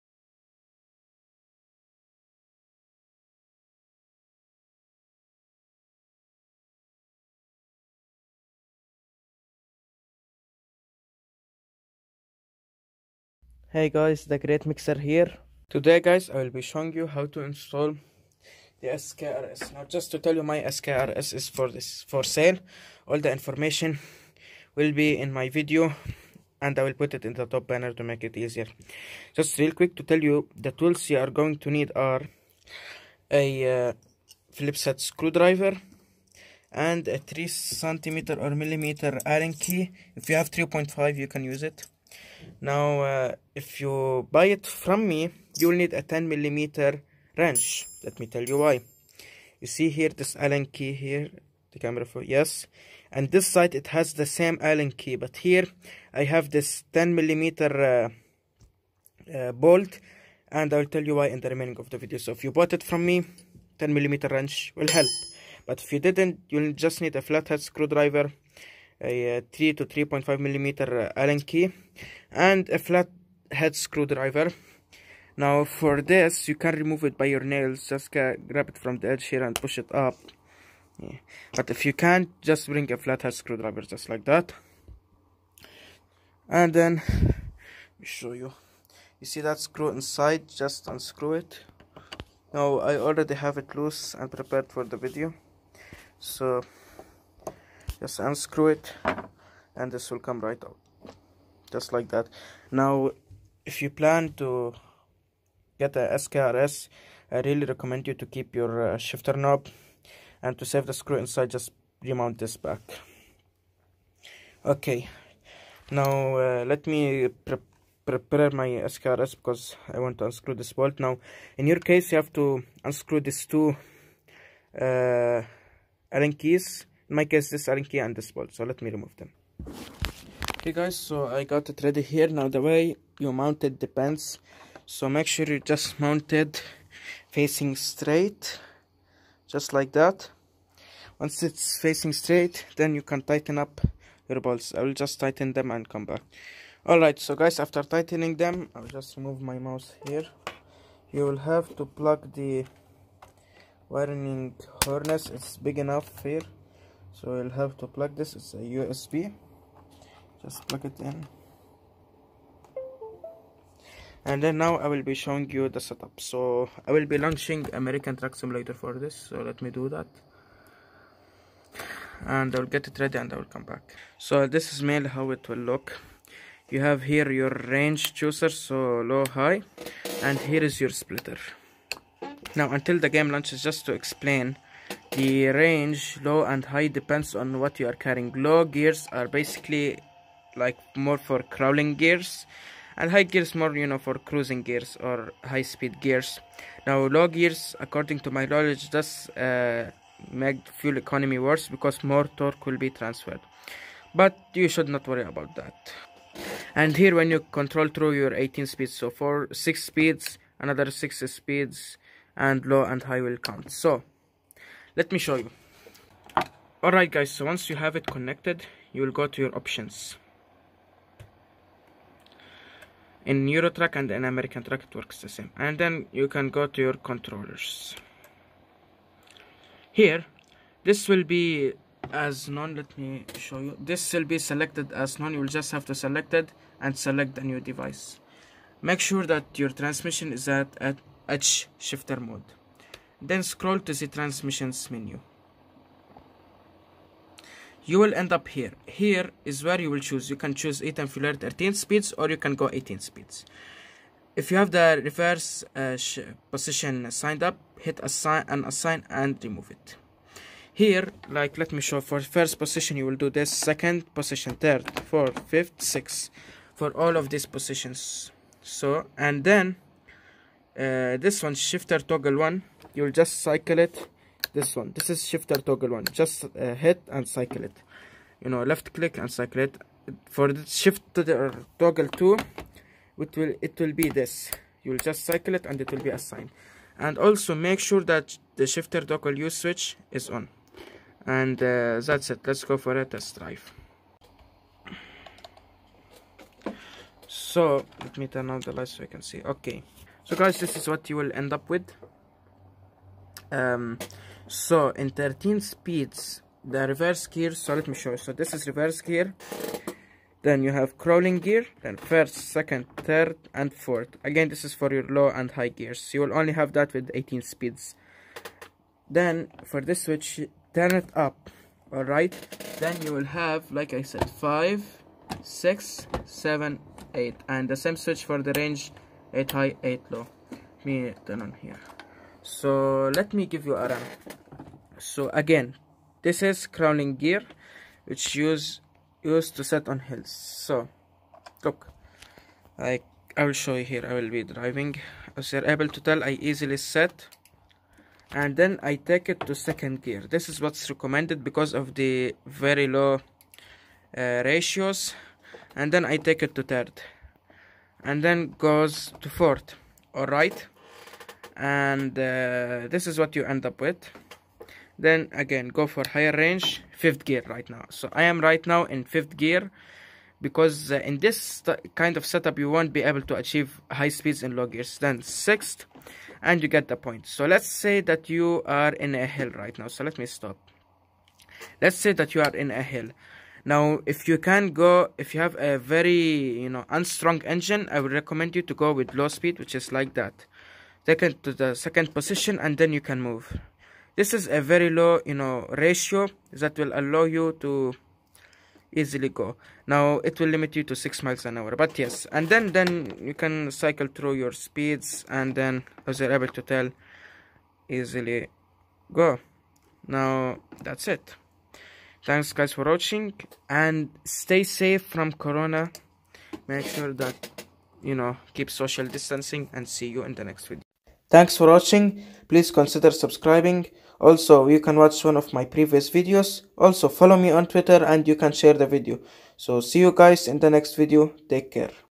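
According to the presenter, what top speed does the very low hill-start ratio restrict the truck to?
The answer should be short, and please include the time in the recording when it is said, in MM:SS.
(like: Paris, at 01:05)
6 miles an hour, at 06:40.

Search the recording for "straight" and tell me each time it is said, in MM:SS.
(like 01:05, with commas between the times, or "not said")
02:17, 02:22.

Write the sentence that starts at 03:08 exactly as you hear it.
Low gears are basically like more for crawling gears and high gears more you know for cruising gears or high speed gears.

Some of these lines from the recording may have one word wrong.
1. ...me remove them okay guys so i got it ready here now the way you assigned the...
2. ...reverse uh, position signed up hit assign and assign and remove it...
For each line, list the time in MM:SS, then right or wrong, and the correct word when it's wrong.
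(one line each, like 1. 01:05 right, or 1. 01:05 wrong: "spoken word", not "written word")
1. 02:08 wrong: "mounted", not "assigned"
2. 04:15 right.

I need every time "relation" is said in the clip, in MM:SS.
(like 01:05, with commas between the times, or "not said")
not said.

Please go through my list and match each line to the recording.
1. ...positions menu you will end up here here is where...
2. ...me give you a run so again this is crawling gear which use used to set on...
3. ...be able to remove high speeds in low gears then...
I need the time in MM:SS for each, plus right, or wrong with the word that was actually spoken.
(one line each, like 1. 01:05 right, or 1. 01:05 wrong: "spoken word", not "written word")
1. 04:04 wrong: "transmissions", not "positions"
2. 05:33 right
3. 06:12 wrong: "achieve", not "remove".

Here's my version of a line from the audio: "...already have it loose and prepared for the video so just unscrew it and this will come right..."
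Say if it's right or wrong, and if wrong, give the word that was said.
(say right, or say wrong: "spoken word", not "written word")
right.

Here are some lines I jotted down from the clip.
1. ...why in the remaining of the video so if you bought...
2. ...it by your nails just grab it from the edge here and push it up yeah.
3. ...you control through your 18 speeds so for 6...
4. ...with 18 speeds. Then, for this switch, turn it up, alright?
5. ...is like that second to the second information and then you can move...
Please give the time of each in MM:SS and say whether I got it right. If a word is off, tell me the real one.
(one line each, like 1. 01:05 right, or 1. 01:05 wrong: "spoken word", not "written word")
1. 01:01 right
2. 01:17 right
3. 03:27 right
4. 05:16 right
5. 06:29 wrong: "position", not "information".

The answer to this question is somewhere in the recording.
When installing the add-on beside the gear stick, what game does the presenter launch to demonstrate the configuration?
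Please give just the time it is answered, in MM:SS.
02:47.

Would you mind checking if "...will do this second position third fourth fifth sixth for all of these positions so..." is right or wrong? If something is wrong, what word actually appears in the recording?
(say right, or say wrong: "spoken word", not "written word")
right.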